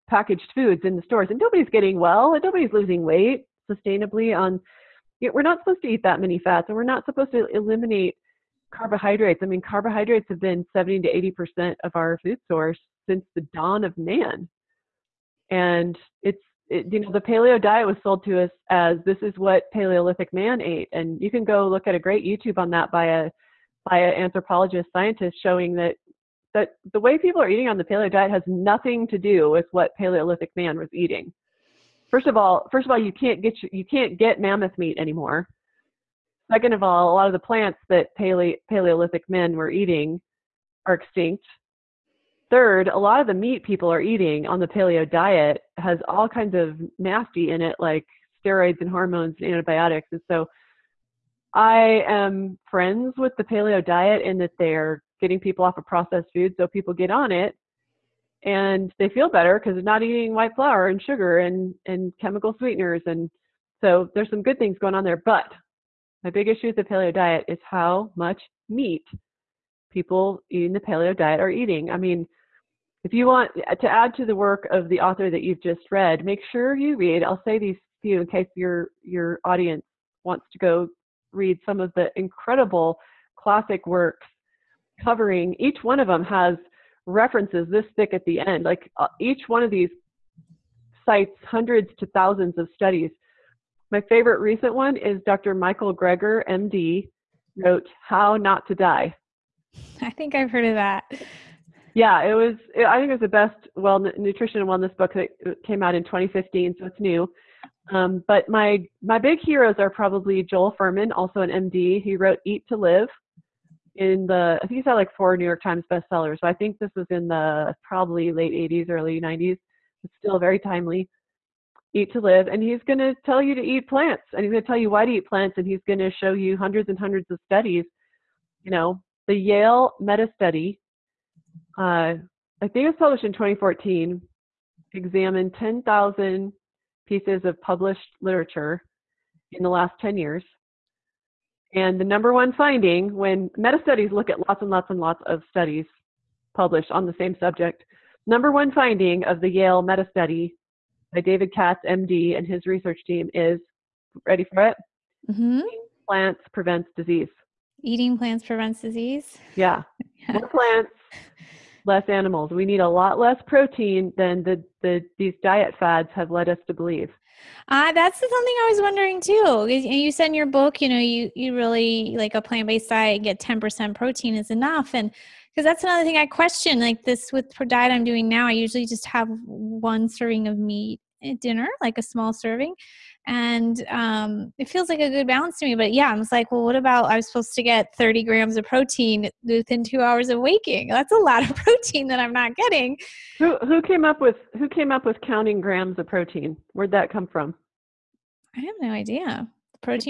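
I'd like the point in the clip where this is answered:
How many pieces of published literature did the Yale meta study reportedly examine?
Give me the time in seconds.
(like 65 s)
135 s.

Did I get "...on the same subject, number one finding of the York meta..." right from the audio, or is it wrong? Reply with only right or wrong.
wrong.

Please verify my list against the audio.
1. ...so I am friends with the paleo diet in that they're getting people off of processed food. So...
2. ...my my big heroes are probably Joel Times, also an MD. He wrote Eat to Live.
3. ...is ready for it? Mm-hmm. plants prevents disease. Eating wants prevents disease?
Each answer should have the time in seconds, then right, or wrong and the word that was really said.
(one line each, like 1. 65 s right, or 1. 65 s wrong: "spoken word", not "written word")
1. 50 s right
2. 108 s wrong: "Fuhrman", not "Times"
3. 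153 s wrong: "plants", not "wants".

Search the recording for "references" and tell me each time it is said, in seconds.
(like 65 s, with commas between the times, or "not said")
87 s.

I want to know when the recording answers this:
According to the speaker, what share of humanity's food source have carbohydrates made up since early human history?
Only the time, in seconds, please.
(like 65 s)
10 s.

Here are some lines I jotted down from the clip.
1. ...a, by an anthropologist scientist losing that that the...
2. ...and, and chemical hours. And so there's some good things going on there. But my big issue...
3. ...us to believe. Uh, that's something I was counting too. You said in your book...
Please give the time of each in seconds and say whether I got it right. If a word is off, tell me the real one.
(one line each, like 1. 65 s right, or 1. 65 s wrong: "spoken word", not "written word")
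1. 23 s wrong: "showing", not "losing"
2. 61 s wrong: "sweeteners", not "hours"
3. 166 s wrong: "wondering", not "counting".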